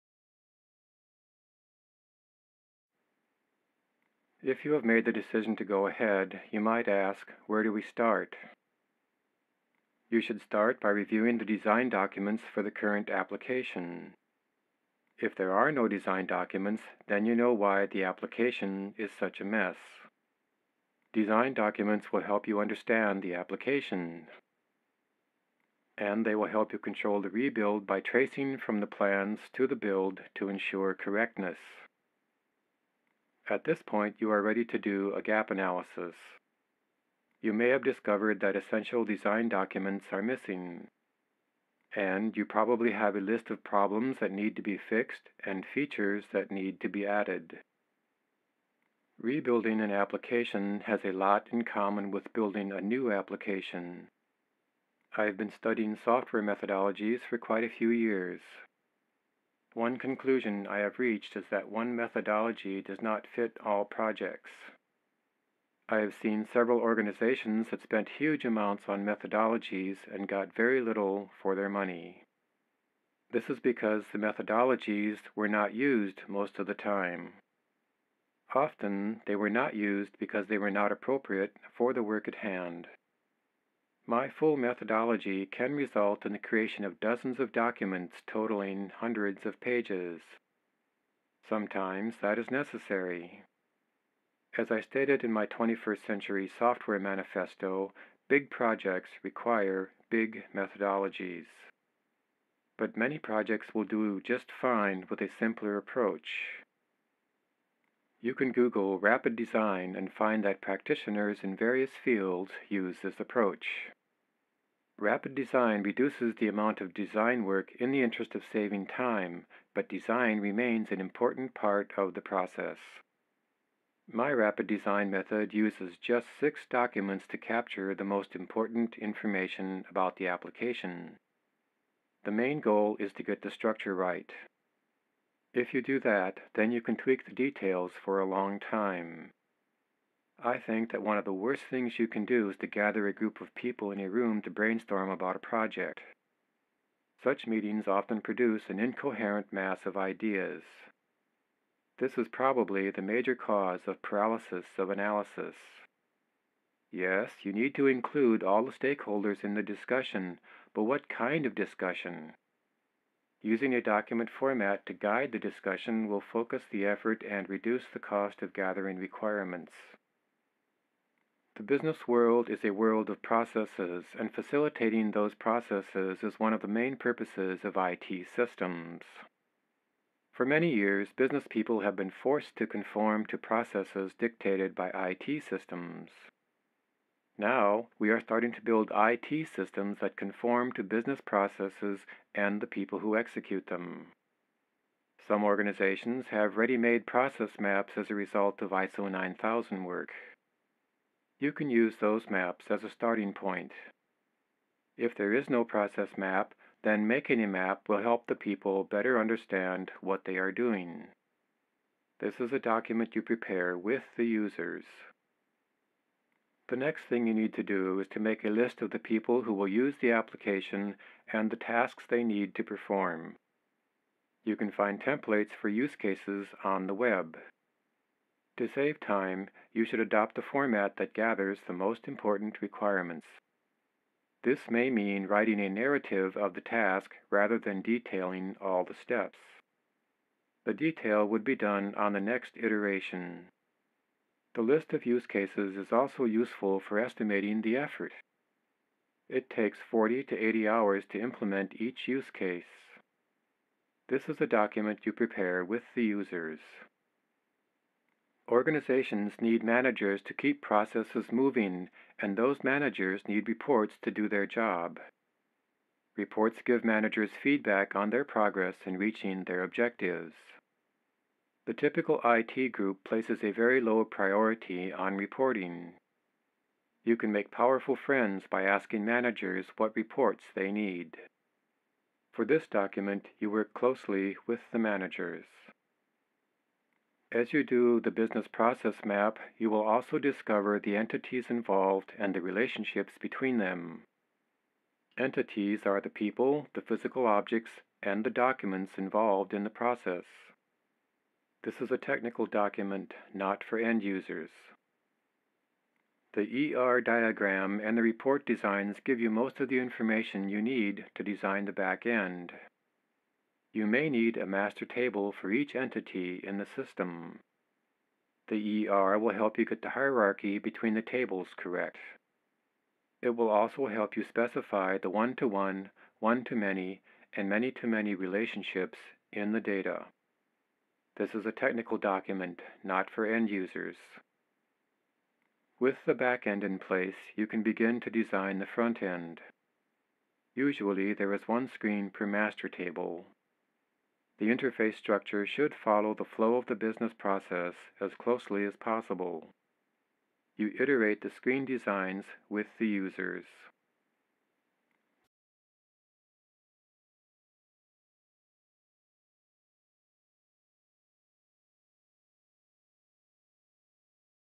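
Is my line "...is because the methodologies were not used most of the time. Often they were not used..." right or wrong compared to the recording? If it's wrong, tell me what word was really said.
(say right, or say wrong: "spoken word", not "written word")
right.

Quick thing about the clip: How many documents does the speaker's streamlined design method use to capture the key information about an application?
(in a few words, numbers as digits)
6.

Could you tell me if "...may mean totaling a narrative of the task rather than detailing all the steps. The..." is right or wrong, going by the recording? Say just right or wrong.
wrong.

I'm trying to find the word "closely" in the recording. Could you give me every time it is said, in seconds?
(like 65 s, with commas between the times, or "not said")
283 s, 348 s.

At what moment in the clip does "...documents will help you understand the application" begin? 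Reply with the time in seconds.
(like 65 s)
21 s.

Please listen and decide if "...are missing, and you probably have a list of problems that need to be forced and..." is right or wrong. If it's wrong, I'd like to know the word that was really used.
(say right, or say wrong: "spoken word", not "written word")
wrong: "fixed", not "forced".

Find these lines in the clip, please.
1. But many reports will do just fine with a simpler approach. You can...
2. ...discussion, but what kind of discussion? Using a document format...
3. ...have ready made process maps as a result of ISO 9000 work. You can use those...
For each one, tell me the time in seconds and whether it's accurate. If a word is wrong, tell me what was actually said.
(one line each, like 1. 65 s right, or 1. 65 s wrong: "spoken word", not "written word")
1. 102 s wrong: "projects", not "reports"
2. 159 s right
3. 196 s right.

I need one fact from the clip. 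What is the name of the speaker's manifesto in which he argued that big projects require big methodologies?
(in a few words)
21st Century Software Manifesto.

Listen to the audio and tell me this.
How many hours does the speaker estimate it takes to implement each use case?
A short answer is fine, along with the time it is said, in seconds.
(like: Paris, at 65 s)
40 to 80 hours, at 249 s.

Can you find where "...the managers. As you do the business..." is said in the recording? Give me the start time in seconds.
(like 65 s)
284 s.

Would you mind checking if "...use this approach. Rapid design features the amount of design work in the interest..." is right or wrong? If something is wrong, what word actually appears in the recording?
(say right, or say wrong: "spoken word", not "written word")
wrong: "reduces", not "features".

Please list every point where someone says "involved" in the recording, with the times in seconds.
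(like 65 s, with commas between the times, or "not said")
291 s, 298 s.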